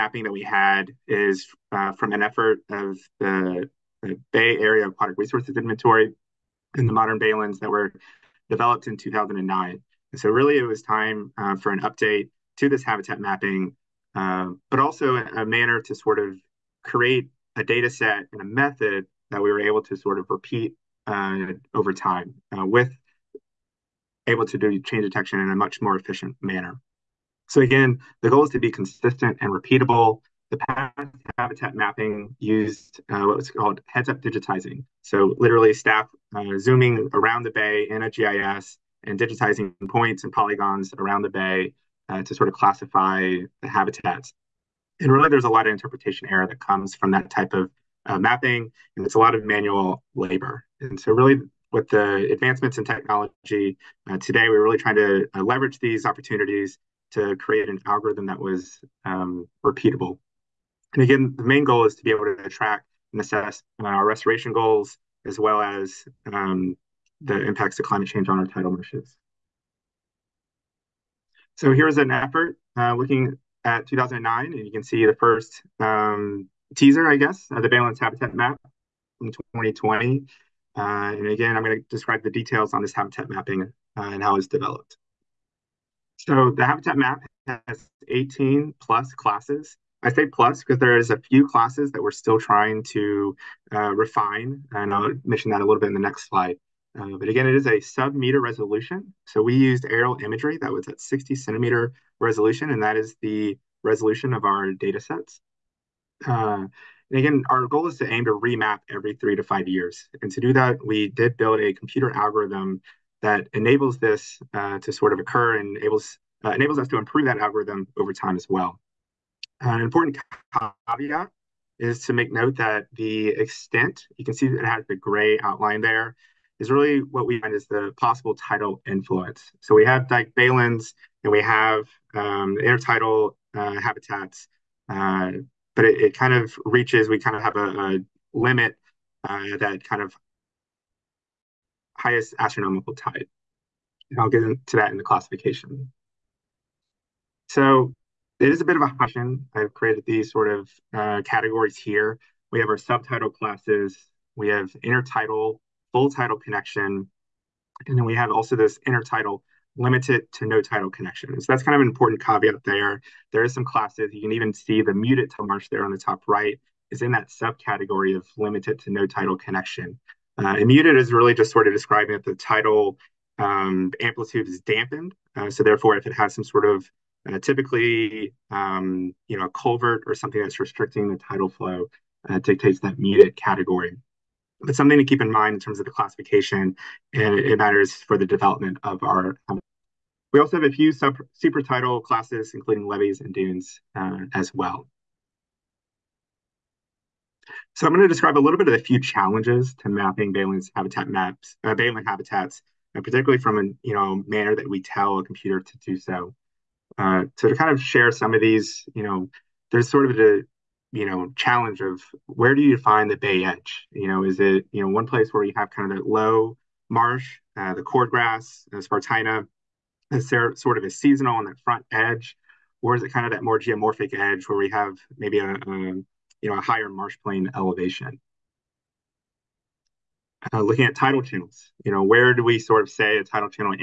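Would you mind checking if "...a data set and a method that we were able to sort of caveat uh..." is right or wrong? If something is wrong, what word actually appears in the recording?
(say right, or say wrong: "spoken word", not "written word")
wrong: "repeat", not "caveat".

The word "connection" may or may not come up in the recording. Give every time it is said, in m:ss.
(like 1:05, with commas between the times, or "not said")
2:36, 2:40, 2:49.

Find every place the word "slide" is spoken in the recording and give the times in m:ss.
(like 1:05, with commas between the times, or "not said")
1:36.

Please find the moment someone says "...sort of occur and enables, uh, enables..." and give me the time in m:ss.
1:54.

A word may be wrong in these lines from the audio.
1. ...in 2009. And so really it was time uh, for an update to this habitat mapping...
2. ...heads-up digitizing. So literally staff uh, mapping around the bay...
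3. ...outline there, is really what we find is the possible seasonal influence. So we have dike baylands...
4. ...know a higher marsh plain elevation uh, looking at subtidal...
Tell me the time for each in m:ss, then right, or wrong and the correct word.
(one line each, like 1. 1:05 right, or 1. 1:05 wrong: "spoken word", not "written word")
1. 0:08 right
2. 0:33 wrong: "zooming", not "mapping"
3. 2:05 wrong: "tidal", not "seasonal"
4. 3:46 wrong: "tidal", not "subtidal".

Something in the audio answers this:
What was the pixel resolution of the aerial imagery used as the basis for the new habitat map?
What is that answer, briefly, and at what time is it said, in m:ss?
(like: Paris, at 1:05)
60 centimeters, at 1:41.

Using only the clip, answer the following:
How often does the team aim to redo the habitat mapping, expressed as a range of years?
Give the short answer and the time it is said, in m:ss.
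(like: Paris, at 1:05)
every 3 to 5 years, at 1:48.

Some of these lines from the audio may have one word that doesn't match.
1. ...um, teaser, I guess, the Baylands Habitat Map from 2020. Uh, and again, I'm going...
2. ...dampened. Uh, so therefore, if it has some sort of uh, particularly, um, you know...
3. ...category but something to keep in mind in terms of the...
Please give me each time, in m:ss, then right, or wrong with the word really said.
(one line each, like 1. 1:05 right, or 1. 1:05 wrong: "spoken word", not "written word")
1. 1:15 right
2. 2:54 wrong: "typically", not "particularly"
3. 3:03 right.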